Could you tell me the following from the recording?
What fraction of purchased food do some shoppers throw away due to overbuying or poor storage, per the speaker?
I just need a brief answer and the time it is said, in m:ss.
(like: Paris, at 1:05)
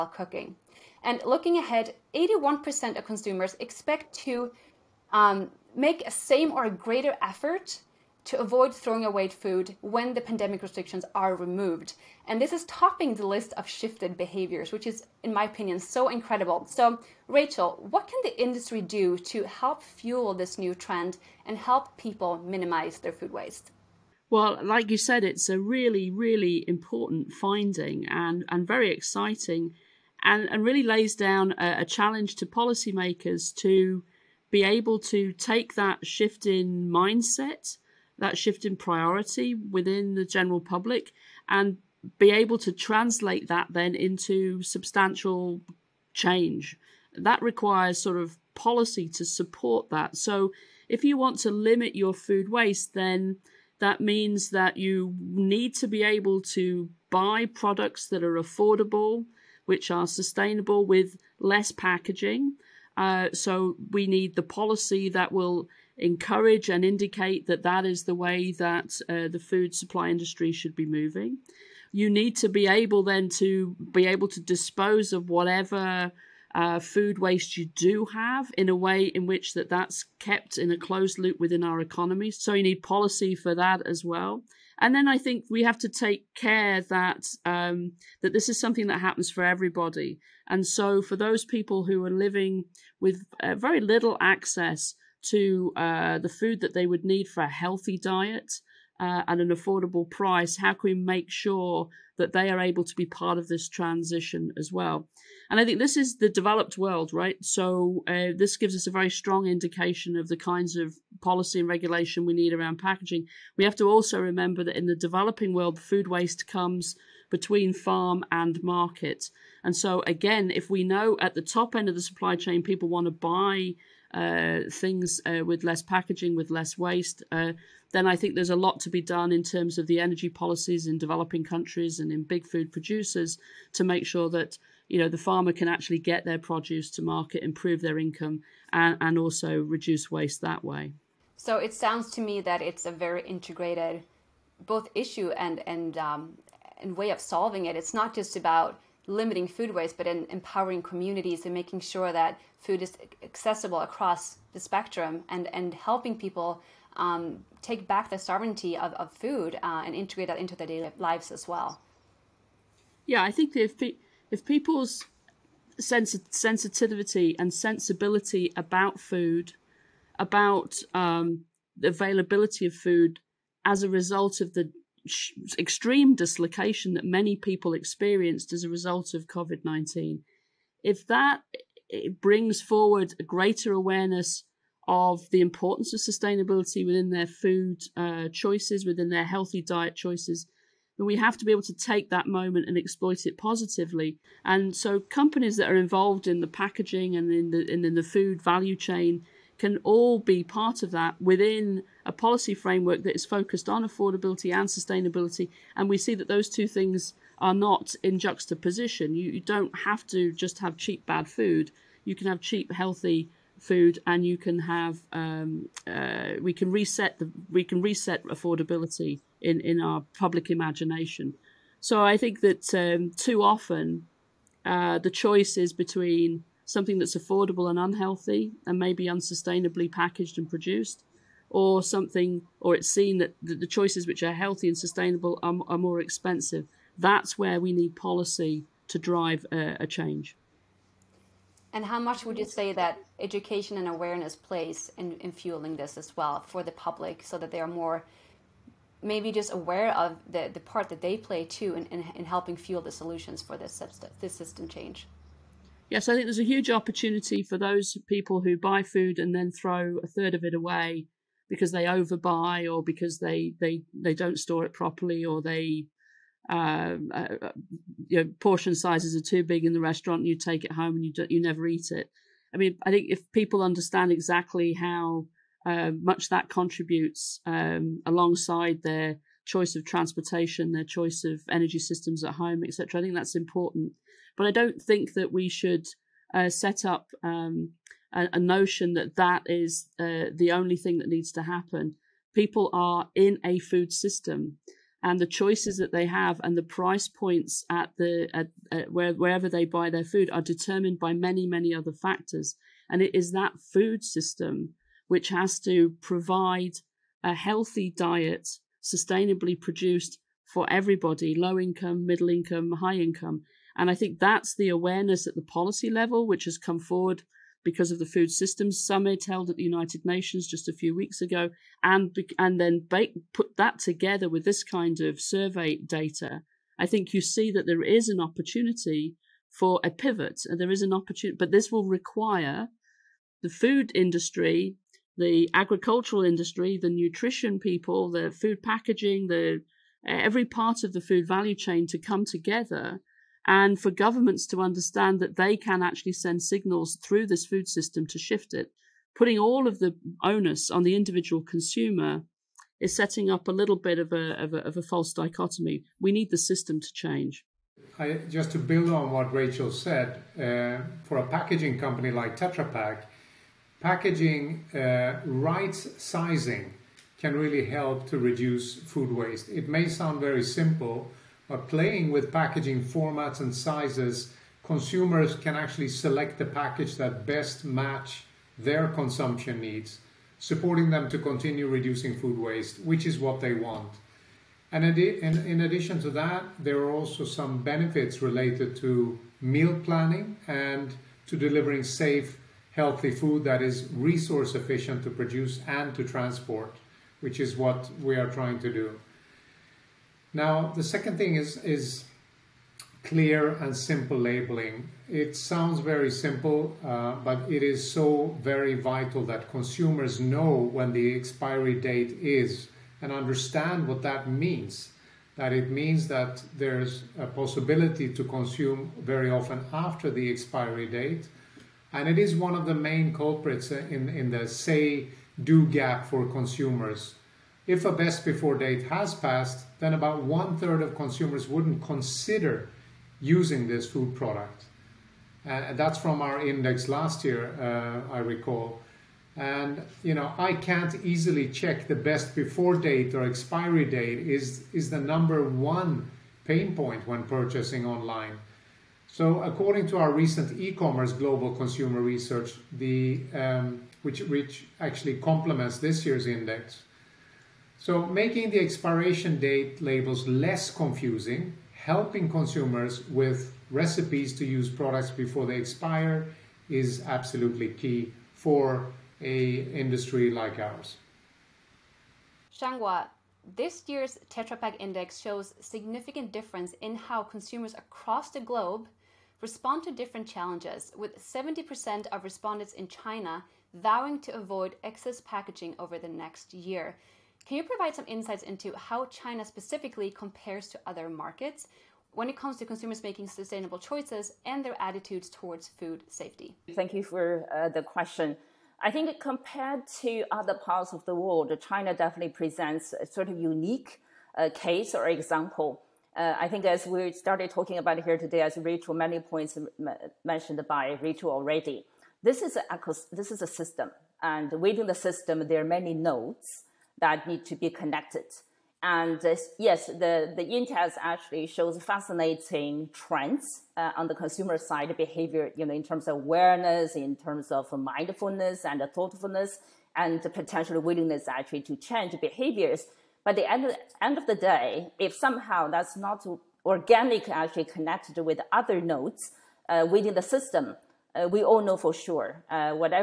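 a third, at 4:20.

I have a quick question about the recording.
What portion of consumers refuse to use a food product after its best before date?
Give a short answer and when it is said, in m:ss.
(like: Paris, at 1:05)
about one third, at 7:09.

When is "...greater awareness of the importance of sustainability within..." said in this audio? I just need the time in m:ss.
3:03.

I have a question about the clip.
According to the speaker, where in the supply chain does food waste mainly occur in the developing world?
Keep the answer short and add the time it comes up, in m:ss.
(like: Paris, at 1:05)
between farm and market, at 1:57.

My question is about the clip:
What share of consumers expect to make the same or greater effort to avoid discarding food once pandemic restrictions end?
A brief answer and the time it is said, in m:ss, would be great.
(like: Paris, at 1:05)
81%, at 0:02.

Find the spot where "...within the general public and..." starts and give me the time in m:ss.
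0:39.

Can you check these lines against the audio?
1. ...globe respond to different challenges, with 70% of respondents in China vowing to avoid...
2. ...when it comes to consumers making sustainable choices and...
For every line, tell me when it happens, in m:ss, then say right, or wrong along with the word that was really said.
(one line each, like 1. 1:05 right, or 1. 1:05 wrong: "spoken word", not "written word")
1. 7:58 right
2. 8:12 right.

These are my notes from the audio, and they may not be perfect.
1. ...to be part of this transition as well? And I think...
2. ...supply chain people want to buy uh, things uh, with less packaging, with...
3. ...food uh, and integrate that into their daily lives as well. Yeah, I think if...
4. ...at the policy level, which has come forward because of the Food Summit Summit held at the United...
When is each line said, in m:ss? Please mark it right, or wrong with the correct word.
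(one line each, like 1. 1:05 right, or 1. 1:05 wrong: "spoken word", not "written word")
1. 1:42 right
2. 2:02 right
3. 2:39 right
4. 5:15 wrong: "Systems", not "Summit".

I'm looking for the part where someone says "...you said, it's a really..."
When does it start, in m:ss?
0:24.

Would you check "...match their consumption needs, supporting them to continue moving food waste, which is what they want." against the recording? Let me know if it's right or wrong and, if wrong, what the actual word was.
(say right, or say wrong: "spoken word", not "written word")
wrong: "reducing", not "moving".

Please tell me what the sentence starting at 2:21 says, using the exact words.
So it sounds to me that it's a very integrated both issue and and um, and way of solving it.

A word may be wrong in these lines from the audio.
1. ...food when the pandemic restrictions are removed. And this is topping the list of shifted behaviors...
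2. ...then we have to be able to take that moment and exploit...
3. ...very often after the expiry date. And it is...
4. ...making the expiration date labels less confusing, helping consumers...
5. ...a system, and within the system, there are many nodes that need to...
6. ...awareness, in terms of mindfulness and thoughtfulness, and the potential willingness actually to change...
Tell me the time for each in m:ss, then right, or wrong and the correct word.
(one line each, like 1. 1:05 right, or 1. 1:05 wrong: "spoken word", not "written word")
1. 0:09 right
2. 3:10 right
3. 6:58 right
4. 7:38 right
5. 8:33 right
6. 8:46 right.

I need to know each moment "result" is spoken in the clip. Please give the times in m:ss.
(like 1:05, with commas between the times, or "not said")
2:53, 2:58.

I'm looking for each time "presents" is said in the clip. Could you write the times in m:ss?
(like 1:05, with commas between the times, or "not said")
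8:22.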